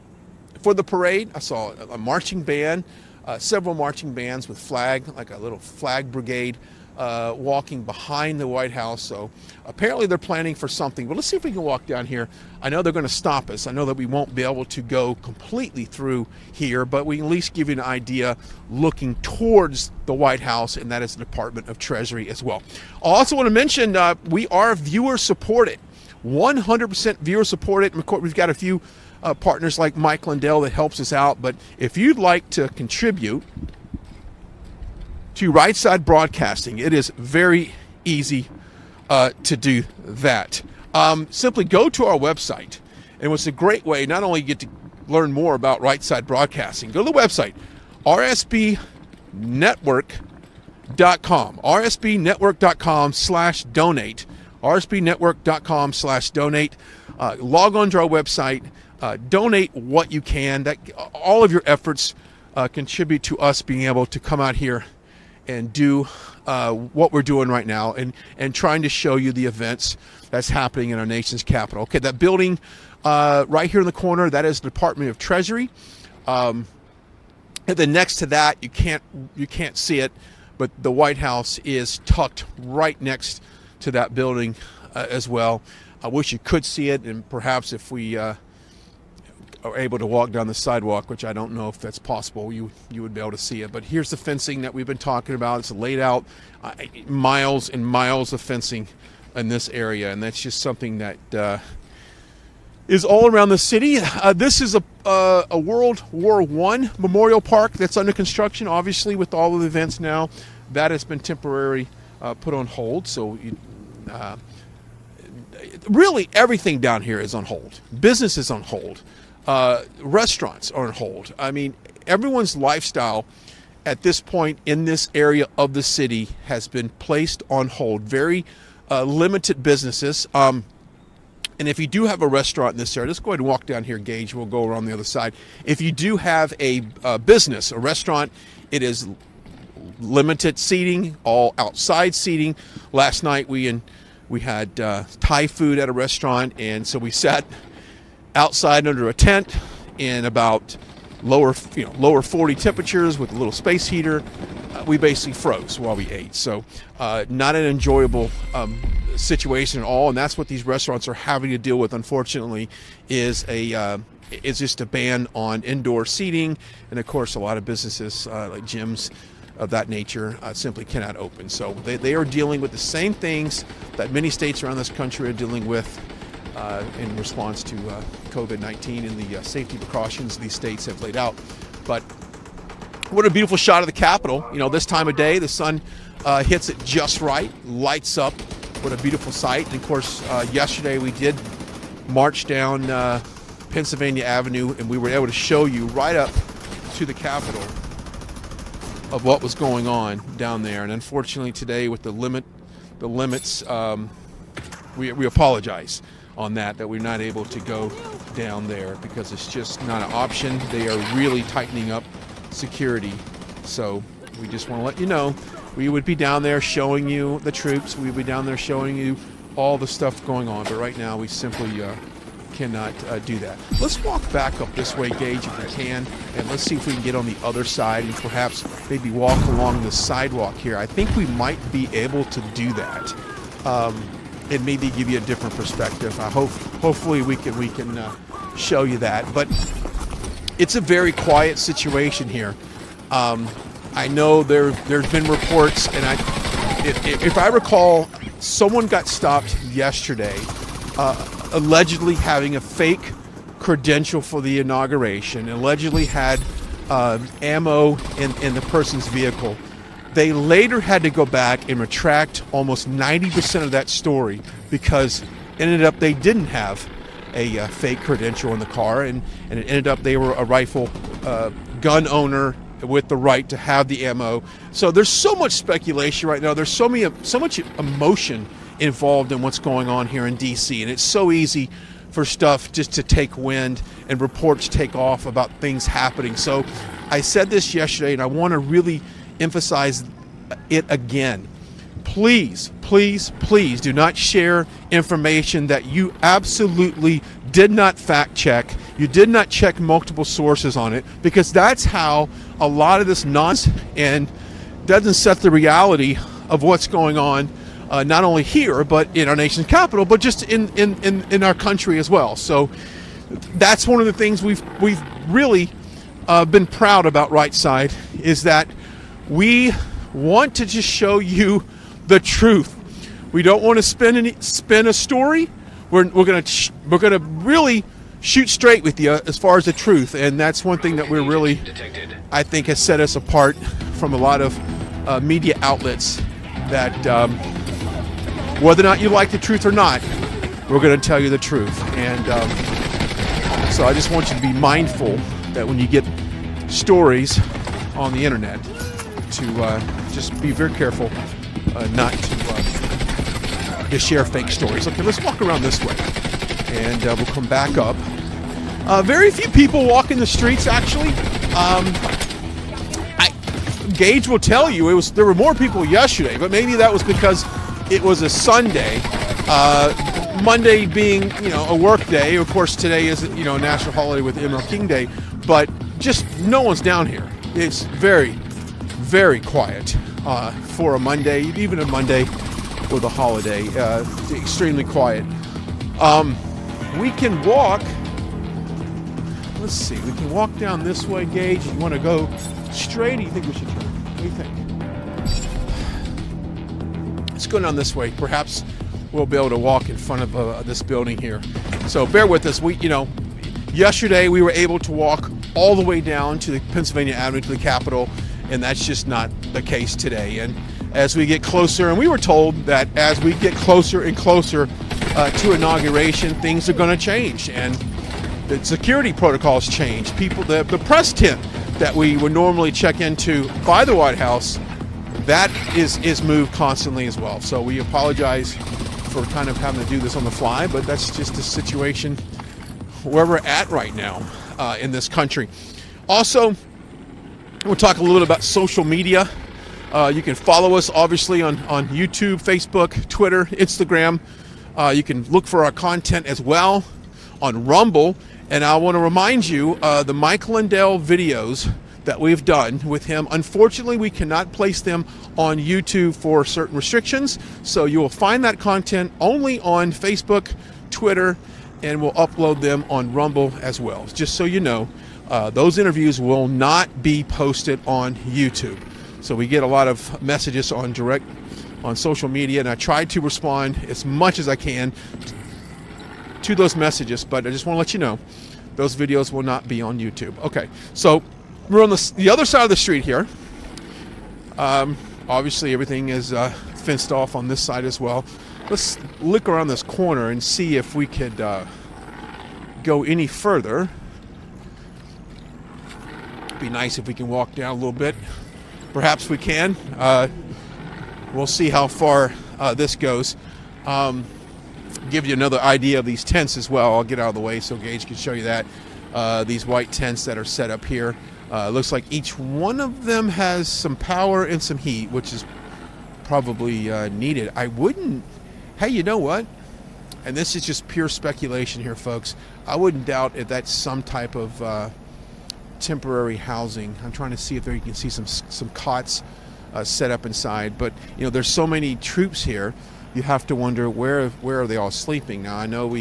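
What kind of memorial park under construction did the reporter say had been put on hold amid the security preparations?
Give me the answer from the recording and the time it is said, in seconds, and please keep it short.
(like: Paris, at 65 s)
World War One, at 105 s.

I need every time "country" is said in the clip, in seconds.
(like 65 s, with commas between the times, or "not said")
174 s, 311 s, 435 s.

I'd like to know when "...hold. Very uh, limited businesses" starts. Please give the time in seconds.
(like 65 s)
127 s.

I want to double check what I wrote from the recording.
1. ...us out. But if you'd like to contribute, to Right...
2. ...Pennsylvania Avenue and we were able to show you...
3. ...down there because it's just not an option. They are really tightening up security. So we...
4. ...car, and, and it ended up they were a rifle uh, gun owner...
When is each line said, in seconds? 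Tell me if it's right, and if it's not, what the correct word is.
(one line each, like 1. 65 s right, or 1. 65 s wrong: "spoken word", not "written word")
1. 31 s right
2. 193 s right
3. 208 s right
4. 268 s right.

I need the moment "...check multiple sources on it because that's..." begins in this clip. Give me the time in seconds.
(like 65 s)
299 s.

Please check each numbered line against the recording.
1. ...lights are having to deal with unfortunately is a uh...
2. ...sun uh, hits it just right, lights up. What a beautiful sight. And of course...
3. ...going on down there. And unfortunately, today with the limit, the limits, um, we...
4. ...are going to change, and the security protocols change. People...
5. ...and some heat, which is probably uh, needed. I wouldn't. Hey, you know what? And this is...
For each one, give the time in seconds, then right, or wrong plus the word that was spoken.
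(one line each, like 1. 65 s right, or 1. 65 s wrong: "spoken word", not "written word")
1. 160 s wrong: "restaurants", not "lights"
2. 185 s right
3. 199 s right
4. 416 s right
5. 514 s right.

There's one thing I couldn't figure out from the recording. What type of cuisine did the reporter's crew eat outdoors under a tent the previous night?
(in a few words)
Thai.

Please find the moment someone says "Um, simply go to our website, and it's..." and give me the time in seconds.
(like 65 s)
40 s.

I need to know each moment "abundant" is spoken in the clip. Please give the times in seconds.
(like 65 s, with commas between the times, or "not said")
not said.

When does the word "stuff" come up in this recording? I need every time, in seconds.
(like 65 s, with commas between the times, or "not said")
219 s, 282 s.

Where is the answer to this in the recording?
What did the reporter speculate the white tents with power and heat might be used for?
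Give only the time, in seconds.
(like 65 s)
525 s.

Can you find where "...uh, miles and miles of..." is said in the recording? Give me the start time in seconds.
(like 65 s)
96 s.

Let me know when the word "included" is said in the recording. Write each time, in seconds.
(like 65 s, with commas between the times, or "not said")
not said.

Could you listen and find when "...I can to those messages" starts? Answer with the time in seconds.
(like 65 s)
474 s.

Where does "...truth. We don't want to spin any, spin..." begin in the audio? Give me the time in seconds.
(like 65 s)
322 s.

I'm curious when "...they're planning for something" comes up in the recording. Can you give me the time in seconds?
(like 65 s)
10 s.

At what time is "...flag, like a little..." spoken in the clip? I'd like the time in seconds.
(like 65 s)
4 s.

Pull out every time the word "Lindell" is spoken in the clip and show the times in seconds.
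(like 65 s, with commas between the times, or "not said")
30 s, 450 s.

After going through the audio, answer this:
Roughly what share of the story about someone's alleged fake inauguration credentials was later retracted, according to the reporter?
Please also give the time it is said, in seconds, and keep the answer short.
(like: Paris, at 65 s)
90%, at 262 s.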